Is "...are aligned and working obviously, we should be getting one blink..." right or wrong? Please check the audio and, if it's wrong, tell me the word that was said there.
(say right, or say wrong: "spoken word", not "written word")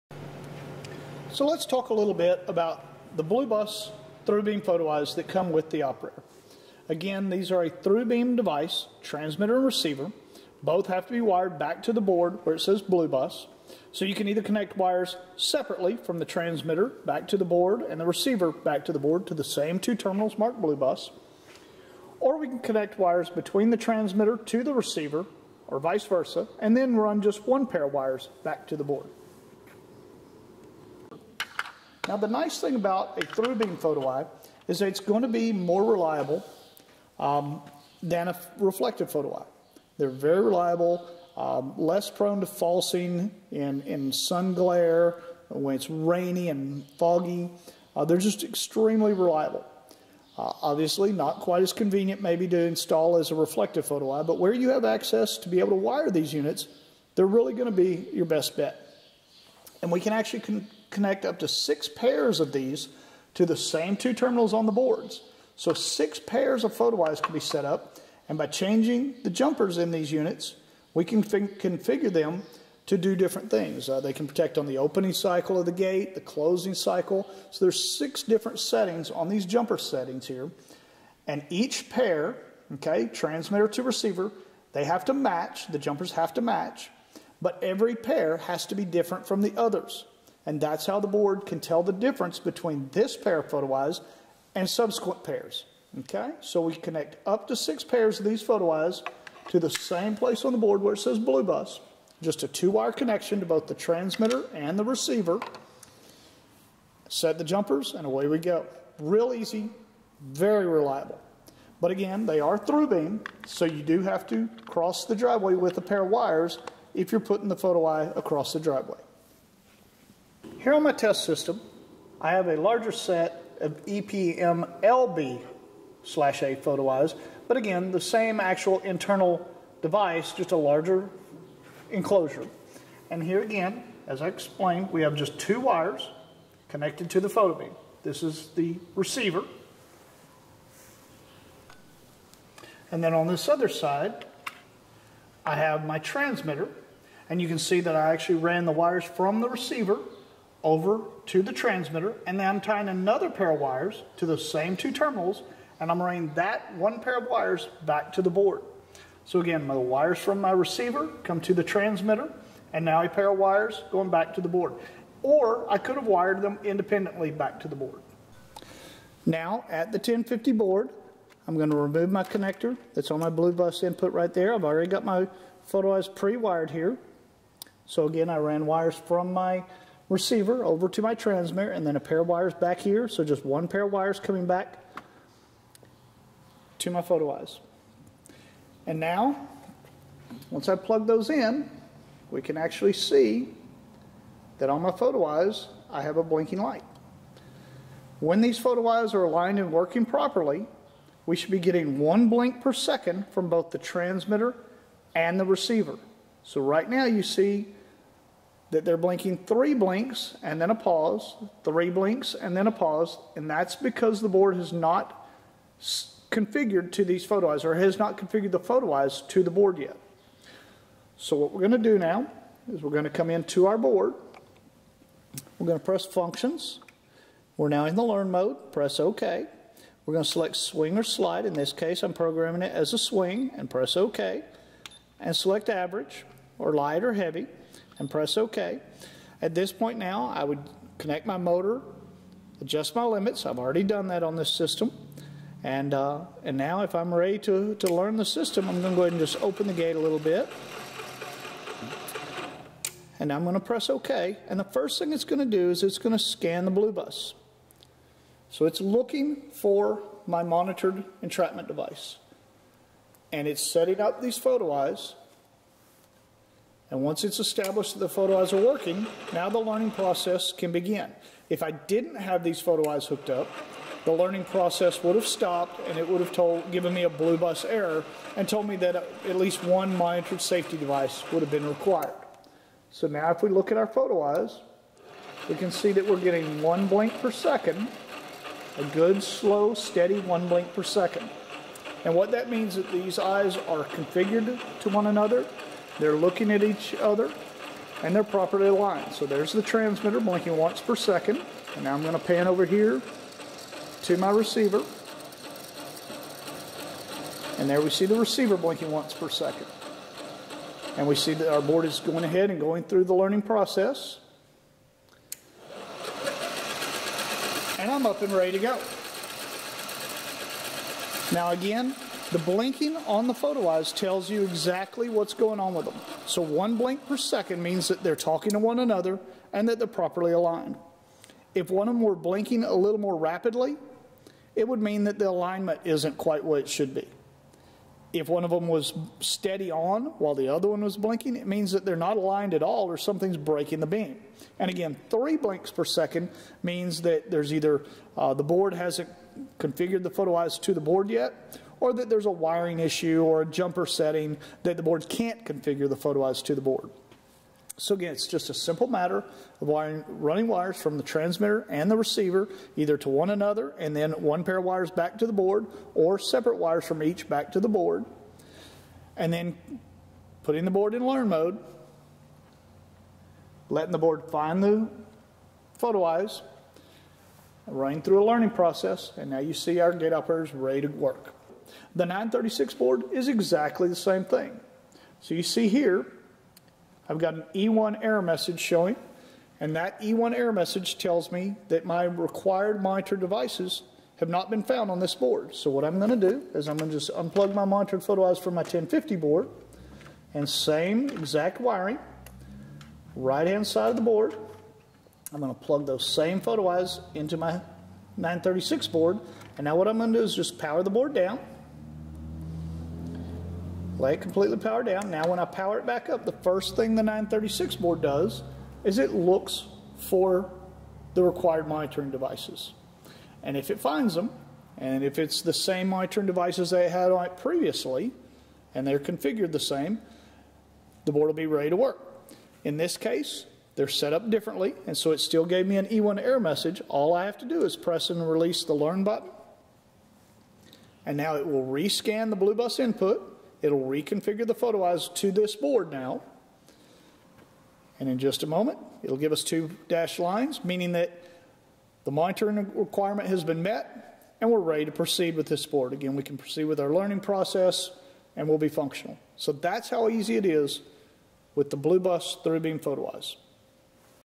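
wrong: "properly", not "obviously".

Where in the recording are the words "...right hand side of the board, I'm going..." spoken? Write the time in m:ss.
6:43.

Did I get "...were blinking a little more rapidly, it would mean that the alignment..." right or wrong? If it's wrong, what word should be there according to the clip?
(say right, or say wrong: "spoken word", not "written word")
right.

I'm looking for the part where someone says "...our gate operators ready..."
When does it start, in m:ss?
6:19.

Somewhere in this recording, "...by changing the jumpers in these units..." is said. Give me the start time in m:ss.
1:08.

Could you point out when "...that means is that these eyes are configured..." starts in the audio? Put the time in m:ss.
4:52.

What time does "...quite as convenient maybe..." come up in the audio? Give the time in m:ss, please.
0:51.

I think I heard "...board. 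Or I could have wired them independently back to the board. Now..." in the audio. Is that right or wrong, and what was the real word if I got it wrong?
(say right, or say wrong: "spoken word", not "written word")
right.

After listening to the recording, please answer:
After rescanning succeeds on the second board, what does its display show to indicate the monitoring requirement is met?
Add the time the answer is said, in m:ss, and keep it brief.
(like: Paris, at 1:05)
two dashed lines, at 7:29.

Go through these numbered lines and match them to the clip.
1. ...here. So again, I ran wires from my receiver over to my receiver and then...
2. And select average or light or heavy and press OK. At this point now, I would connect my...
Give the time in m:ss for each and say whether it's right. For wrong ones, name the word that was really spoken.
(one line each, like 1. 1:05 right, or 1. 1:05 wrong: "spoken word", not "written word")
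1. 2:56 wrong: "transmitter", not "receiver"
2. 3:55 right.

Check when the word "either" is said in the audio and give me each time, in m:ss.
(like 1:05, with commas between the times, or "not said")
0:14, 5:47, 6:02.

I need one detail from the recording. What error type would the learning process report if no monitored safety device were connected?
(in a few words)
Blue Bus error.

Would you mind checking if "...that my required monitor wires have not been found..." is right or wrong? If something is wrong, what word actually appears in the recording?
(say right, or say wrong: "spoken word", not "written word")
wrong: "devices", not "wires".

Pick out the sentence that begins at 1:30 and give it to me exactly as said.
And that's how the board can tell the difference between this pair of photo eyes and subsequent pairs.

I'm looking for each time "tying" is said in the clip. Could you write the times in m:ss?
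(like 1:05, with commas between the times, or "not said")
2:32.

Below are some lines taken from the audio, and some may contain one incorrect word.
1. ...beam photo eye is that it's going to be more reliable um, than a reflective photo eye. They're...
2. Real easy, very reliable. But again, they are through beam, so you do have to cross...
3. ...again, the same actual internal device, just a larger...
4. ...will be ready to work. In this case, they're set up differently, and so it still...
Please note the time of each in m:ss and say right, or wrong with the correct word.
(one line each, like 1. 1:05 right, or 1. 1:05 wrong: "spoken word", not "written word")
1. 0:33 right
2. 1:48 right
3. 2:07 right
4. 7:11 right.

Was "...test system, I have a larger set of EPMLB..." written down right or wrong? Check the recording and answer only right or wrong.
right.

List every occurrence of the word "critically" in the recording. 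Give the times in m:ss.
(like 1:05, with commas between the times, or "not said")
not said.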